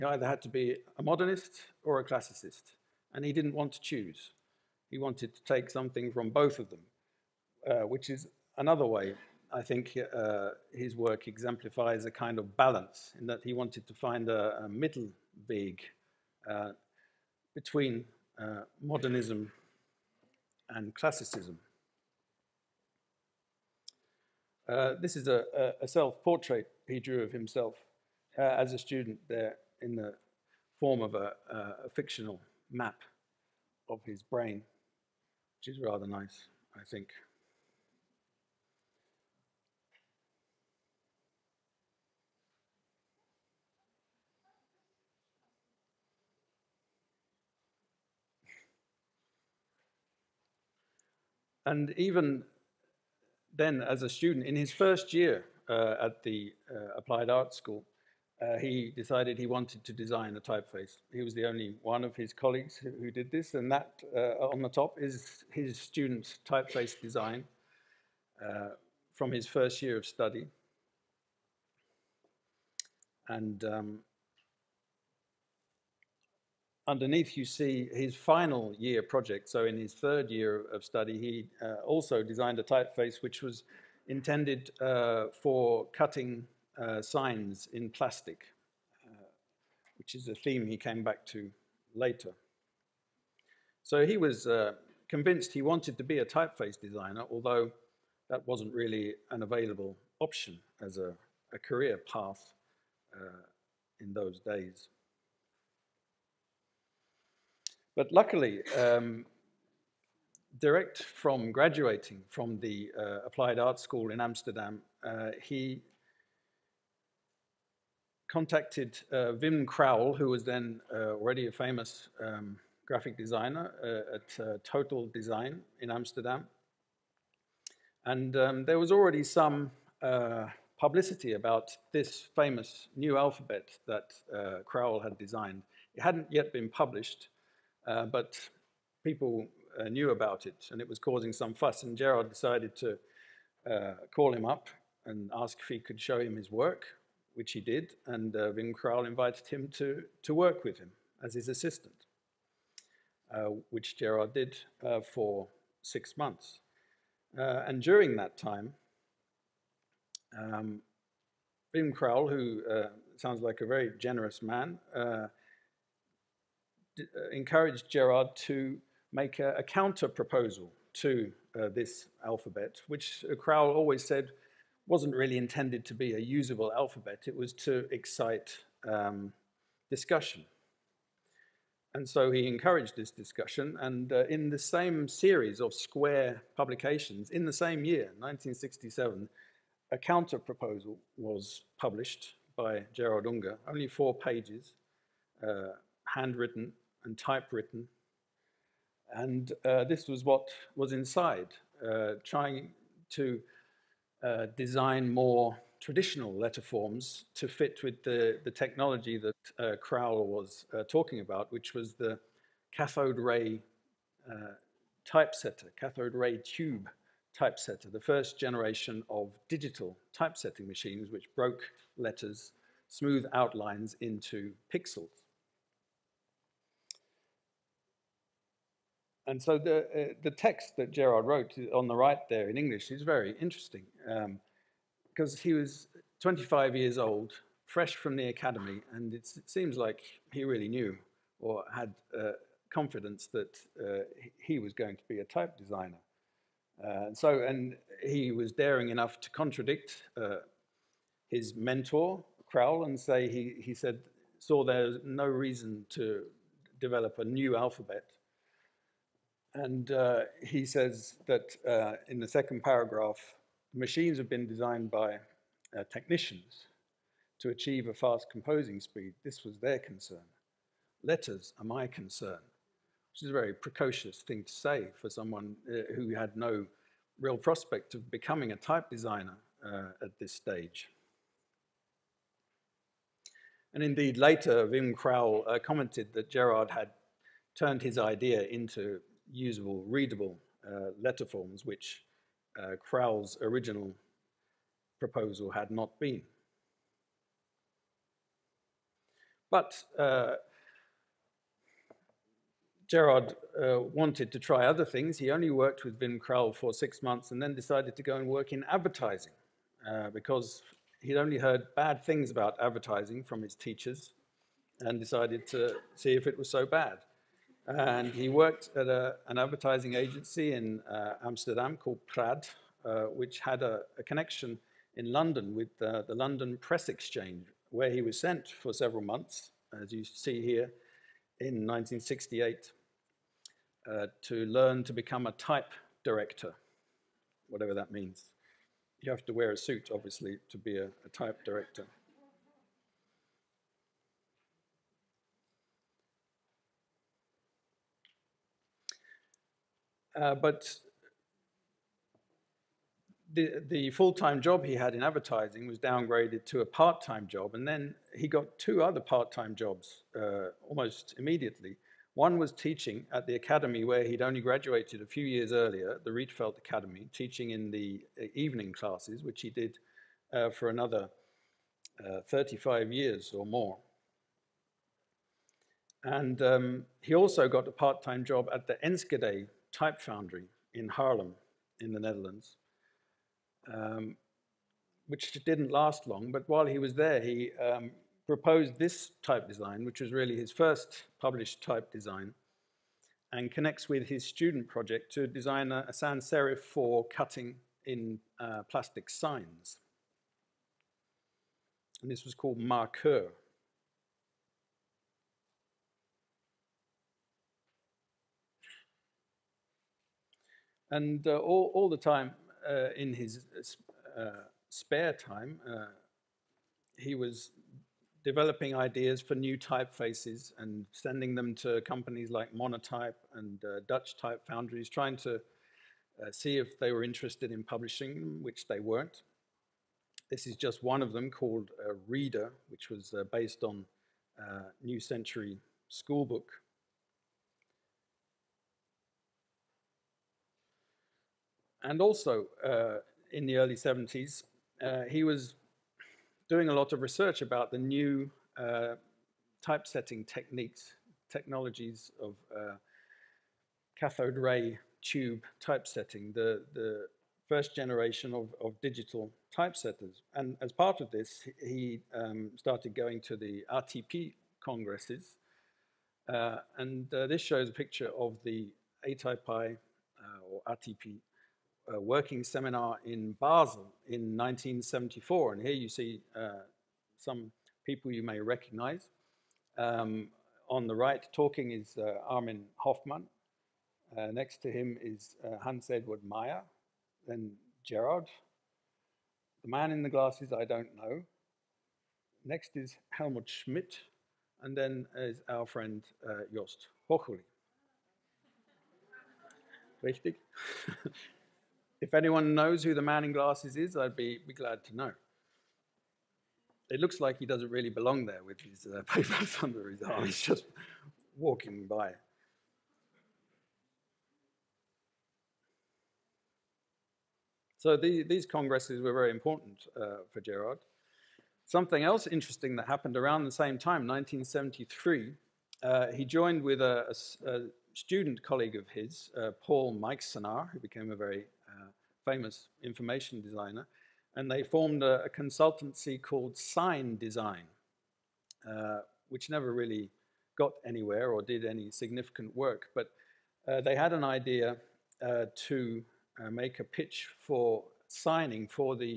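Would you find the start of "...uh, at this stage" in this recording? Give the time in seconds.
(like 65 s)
279 s.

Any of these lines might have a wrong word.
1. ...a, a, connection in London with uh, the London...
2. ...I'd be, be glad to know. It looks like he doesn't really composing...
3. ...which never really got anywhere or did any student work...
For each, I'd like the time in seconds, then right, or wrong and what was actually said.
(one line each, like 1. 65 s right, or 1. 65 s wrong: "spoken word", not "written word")
1. 323 s right
2. 503 s wrong: "belong", not "composing"
3. 539 s wrong: "significant", not "student".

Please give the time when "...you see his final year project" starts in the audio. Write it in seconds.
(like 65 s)
77 s.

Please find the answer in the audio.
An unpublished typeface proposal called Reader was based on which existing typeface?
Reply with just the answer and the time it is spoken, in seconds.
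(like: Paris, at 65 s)
New Century Schoolbook, at 434 s.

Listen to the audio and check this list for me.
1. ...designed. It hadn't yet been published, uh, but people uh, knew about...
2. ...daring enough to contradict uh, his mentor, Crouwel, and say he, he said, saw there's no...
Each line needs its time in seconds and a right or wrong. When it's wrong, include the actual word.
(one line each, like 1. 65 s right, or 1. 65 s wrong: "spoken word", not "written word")
1. 135 s right
2. 248 s right.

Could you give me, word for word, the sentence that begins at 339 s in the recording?
You have to wear a suit, obviously, to be a, a type director.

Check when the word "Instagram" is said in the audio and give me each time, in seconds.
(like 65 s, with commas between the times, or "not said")
not said.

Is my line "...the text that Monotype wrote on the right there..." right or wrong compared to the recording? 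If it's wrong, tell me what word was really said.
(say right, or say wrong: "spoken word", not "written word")
wrong: "Gerard", not "Monotype".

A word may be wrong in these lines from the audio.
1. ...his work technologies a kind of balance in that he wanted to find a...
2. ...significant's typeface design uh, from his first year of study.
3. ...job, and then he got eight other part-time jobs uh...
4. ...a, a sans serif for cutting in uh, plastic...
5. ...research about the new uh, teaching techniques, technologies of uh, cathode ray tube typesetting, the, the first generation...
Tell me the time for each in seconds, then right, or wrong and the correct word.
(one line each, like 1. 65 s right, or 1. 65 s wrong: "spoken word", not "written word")
1. 10 s wrong: "exemplifies", not "technologies"
2. 65 s wrong: "student", not "significant"
3. 357 s wrong: "two", not "eight"
4. 395 s right
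5. 447 s wrong: "typesetting", not "teaching".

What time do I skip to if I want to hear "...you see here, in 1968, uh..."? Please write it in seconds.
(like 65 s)
329 s.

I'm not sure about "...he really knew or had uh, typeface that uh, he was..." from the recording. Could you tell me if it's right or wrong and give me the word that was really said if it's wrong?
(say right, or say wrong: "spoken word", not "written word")
wrong: "confidence", not "typeface".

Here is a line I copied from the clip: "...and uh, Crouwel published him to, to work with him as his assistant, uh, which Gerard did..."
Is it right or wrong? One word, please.
wrong.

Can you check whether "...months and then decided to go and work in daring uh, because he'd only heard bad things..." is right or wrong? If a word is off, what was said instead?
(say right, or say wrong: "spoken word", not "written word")
wrong: "advertising", not "daring".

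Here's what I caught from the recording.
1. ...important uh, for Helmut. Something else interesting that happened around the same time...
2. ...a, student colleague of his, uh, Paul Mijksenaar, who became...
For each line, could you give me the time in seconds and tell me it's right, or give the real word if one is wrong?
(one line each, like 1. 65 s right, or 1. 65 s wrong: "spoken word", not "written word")
1. 519 s wrong: "Gerard", not "Helmut"
2. 527 s right.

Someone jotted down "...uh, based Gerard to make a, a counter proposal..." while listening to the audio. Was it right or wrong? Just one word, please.
wrong.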